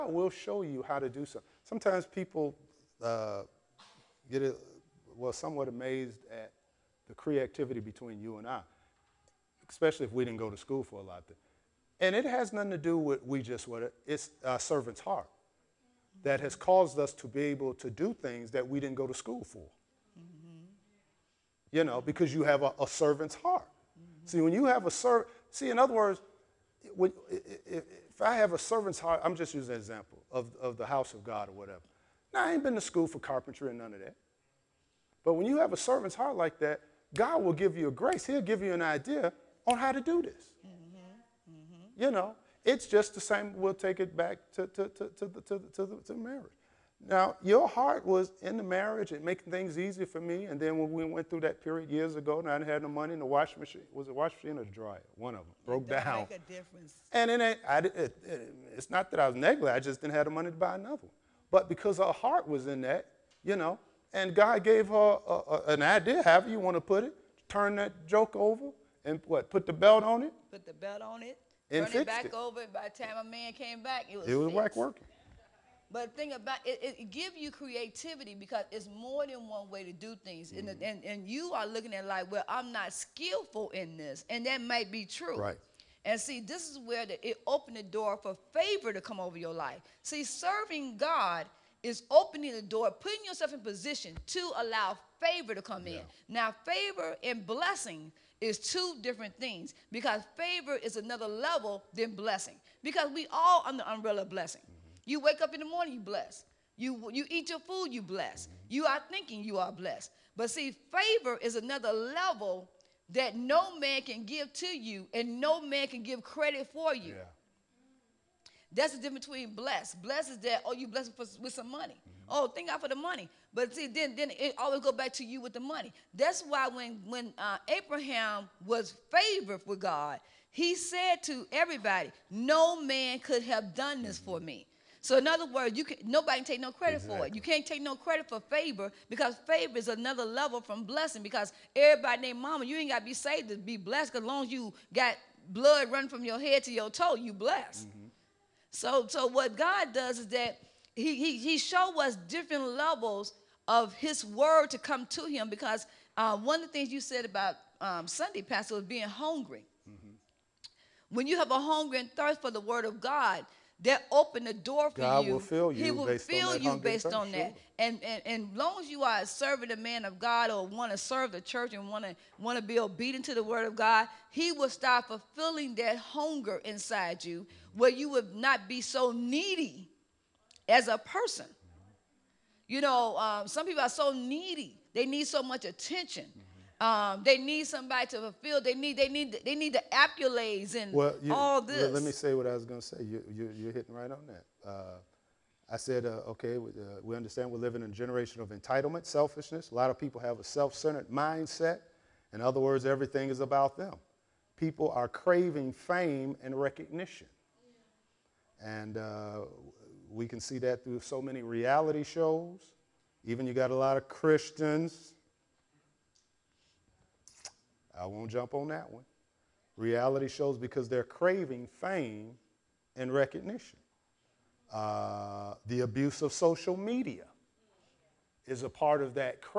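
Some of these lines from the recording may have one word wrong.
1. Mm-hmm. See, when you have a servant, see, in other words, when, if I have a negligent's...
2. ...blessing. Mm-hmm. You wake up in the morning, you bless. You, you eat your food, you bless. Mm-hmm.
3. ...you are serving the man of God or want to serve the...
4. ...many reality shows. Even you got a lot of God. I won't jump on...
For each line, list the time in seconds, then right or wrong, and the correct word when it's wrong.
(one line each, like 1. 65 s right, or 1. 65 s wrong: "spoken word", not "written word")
1. 23 s wrong: "servant", not "negligent"
2. 104 s right
3. 168 s right
4. 211 s wrong: "Christians", not "God".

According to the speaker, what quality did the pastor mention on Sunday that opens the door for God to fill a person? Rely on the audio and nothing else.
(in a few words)
being hungry.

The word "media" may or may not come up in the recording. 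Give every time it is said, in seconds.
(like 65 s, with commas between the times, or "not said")
226 s.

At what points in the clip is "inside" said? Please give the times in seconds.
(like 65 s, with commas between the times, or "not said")
176 s.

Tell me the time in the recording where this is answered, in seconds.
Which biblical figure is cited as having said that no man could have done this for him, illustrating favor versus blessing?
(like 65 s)
127 s.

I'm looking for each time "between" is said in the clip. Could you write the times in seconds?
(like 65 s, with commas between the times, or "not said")
7 s, 119 s.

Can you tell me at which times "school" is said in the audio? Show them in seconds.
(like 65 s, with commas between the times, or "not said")
10 s, 19 s, 32 s.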